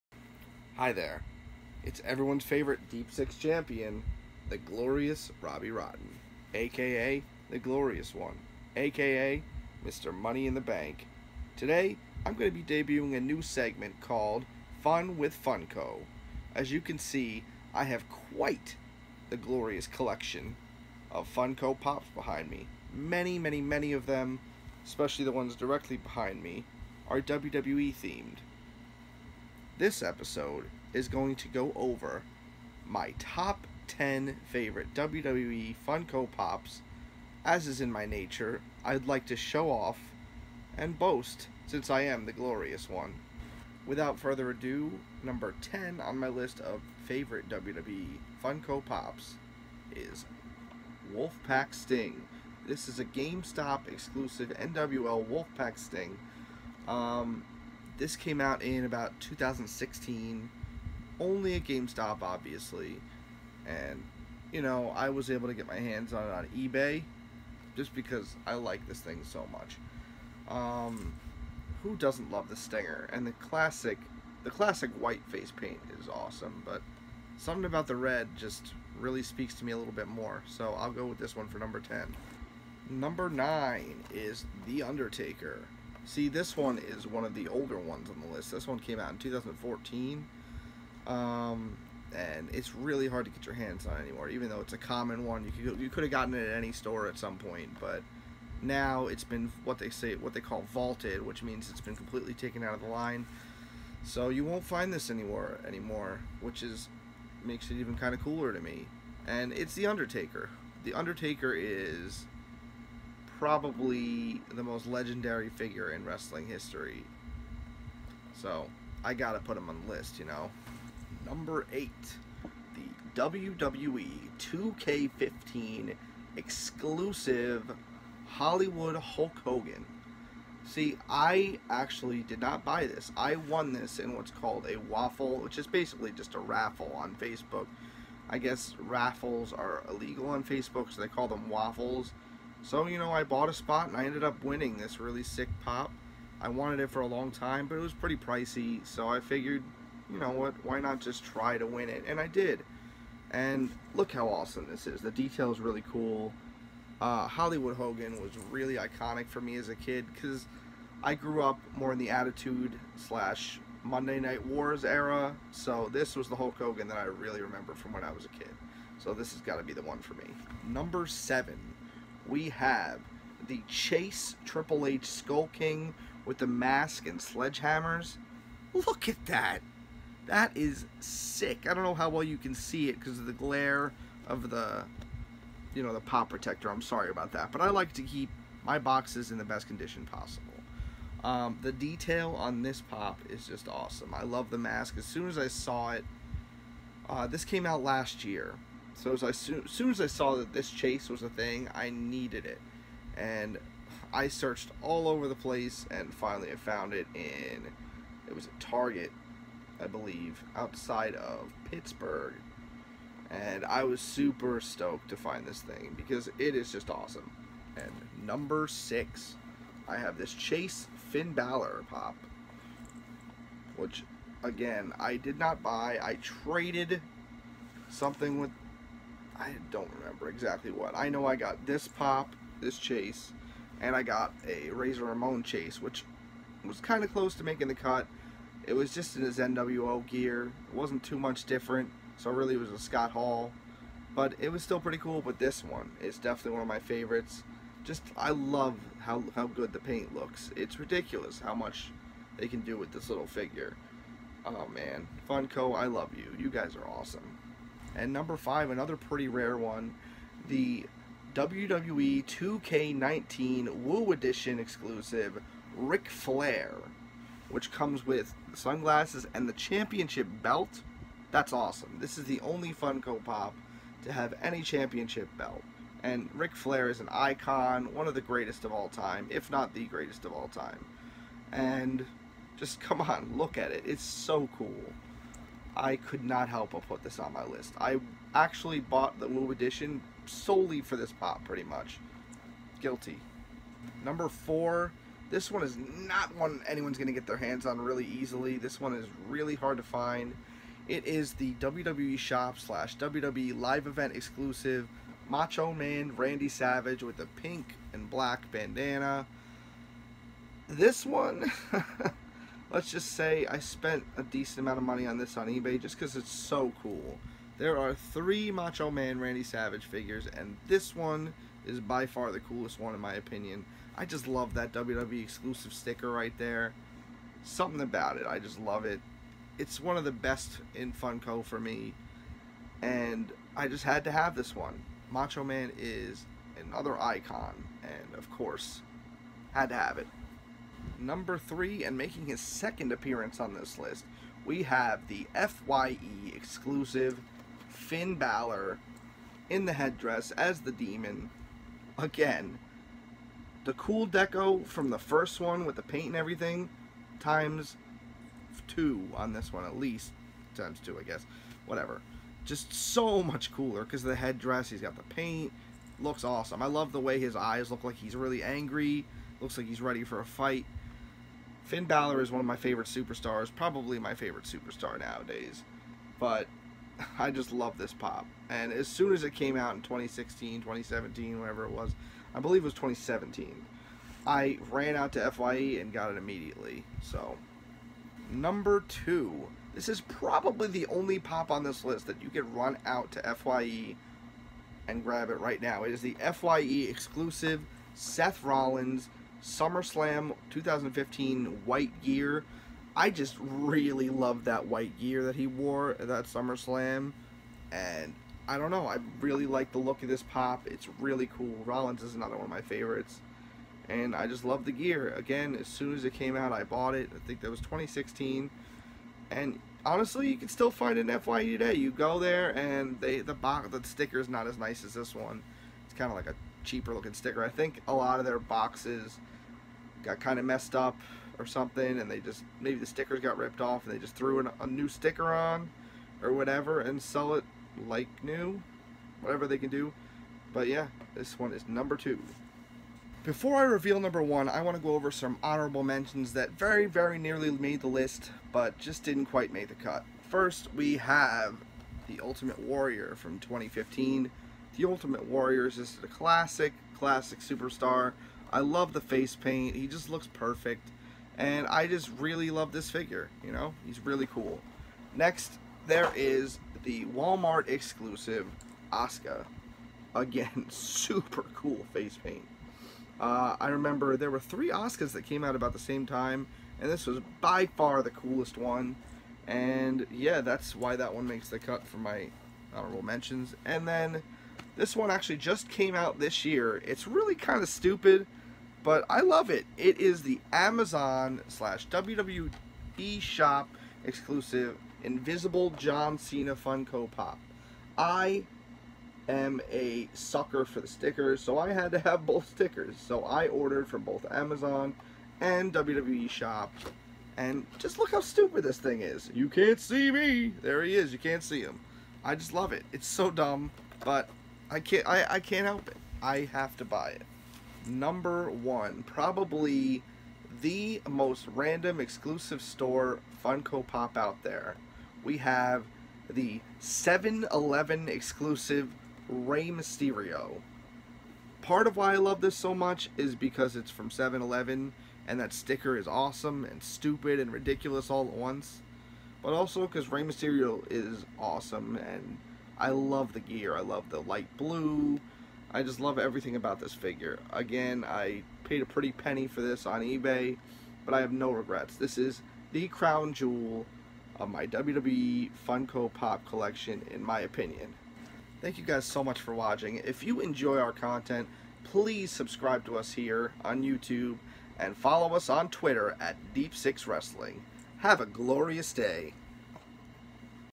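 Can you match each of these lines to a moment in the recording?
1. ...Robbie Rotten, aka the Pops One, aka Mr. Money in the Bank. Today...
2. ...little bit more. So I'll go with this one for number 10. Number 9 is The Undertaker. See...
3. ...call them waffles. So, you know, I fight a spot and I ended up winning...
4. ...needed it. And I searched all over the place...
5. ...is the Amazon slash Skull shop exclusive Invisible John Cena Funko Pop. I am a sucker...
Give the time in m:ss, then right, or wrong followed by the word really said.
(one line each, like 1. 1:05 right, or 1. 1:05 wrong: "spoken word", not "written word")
1. 0:05 wrong: "Glorious", not "Pops"
2. 1:19 right
3. 2:21 wrong: "bought", not "fight"
4. 3:21 right
5. 8:09 wrong: "WWE", not "Skull".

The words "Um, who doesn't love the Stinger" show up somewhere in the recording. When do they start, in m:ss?
1:10.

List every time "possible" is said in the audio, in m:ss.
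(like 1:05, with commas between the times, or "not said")
3:10.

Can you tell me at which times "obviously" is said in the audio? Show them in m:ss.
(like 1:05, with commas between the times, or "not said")
1:02.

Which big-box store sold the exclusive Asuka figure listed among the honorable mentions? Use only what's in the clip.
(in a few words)
Walmart.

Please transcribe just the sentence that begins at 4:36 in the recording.
And Ric Flair is an icon, one of the greatest of all time, if not the greatest of all time.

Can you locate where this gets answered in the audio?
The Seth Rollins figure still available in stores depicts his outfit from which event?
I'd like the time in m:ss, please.
6:39.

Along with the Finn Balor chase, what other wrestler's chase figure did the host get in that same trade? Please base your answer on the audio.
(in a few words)
Razor Ramon.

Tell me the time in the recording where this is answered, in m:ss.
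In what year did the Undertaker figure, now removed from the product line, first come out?
1:29.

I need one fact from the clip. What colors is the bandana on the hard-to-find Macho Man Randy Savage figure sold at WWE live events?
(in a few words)
Pink and black.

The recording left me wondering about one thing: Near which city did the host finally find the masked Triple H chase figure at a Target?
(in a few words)
Pittsburgh.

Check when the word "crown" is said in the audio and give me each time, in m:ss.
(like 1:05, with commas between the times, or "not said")
9:12.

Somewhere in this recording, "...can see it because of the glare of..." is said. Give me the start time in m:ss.
3:02.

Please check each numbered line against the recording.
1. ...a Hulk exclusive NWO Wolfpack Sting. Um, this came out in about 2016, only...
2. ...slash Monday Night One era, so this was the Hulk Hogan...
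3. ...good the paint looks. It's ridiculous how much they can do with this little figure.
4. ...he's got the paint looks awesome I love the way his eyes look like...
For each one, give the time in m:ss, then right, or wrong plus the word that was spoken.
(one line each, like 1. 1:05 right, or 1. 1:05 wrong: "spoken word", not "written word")
1. 0:52 wrong: "GameStop", not "Hulk"
2. 2:42 wrong: "Wars", not "One"
3. 4:09 right
4. 6:04 right.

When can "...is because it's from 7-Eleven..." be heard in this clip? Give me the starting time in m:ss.
8:53.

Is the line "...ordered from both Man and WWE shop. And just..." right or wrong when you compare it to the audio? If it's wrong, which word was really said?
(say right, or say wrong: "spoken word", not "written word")
wrong: "Amazon", not "Man".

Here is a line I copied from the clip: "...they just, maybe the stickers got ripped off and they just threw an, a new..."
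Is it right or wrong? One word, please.
right.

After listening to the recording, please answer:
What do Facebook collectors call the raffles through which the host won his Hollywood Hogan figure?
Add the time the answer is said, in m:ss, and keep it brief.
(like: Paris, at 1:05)
Waffle, at 2:14.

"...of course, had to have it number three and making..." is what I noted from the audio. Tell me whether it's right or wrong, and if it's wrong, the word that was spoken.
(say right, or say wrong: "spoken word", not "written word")
right.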